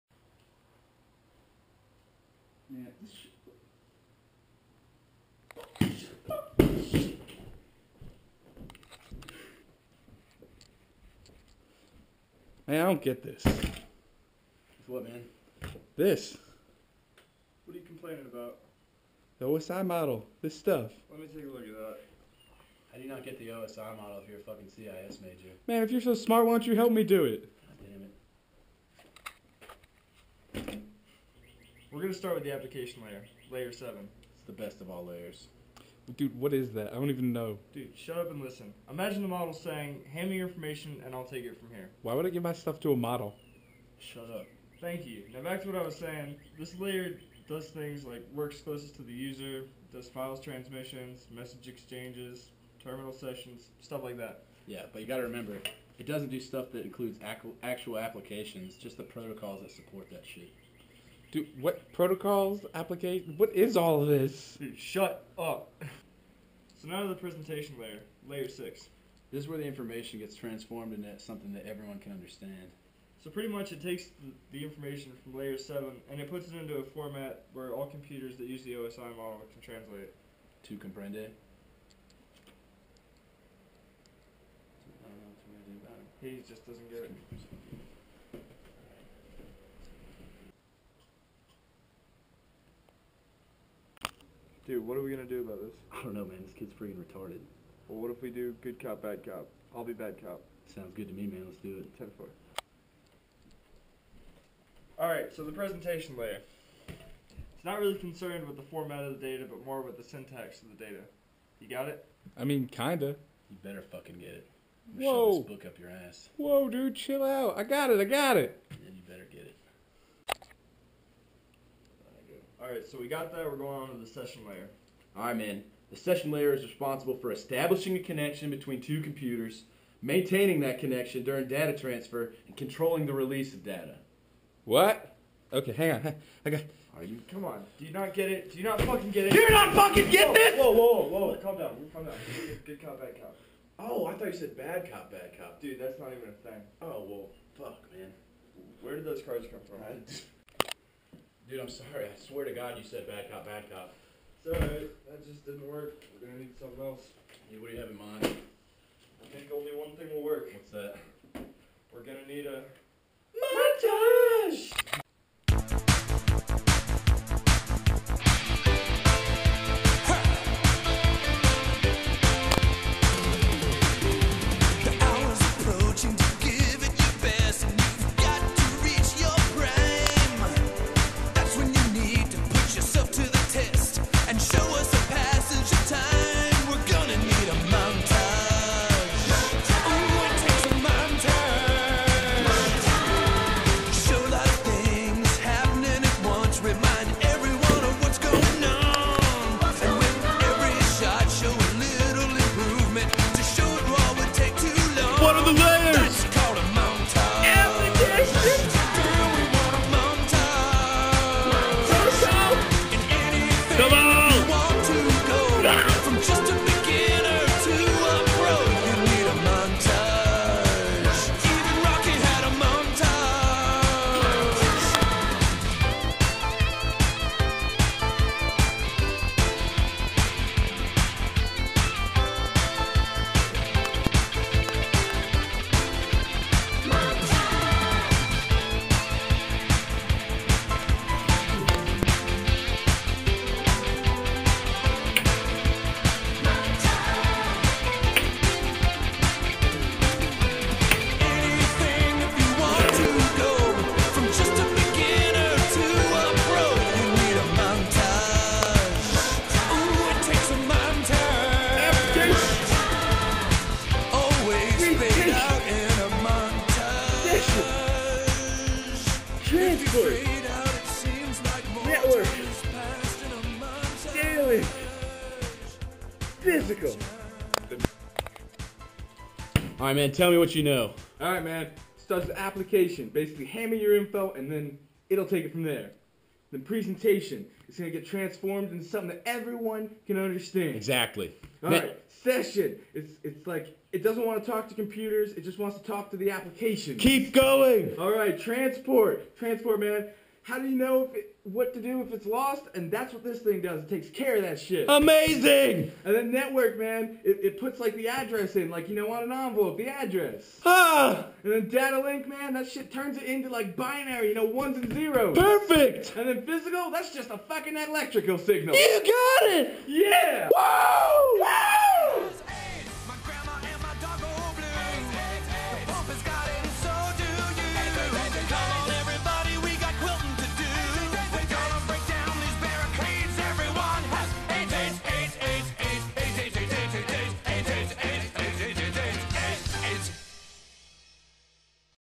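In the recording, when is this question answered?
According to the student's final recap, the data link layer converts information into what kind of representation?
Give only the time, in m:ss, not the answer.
5:13.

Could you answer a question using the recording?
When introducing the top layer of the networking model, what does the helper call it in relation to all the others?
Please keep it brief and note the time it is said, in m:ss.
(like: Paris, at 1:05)
The best of all layers, at 0:34.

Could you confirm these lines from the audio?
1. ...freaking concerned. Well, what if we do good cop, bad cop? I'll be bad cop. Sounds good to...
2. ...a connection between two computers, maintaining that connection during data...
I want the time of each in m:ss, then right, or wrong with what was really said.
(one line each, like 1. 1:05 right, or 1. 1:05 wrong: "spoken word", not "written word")
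1. 1:36 wrong: "retarded", not "concerned"
2. 2:07 right.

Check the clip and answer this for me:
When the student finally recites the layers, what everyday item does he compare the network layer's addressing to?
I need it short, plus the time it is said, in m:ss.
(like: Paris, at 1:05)
An envelope, at 5:09.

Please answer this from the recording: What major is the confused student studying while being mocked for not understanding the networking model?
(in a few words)
CIS.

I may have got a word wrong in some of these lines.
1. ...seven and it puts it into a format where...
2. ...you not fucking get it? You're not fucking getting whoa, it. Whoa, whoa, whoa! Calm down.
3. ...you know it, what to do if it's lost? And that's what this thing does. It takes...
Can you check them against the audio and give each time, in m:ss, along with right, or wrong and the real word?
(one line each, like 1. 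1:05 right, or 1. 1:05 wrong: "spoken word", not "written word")
1. 1:15 right
2. 2:18 right
3. 5:00 right.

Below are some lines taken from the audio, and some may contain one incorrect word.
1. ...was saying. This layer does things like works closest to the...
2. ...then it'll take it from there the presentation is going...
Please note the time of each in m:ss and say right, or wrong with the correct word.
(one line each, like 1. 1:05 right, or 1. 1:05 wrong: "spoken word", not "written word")
1. 0:45 right
2. 4:44 right.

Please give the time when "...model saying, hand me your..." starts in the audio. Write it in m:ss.
0:39.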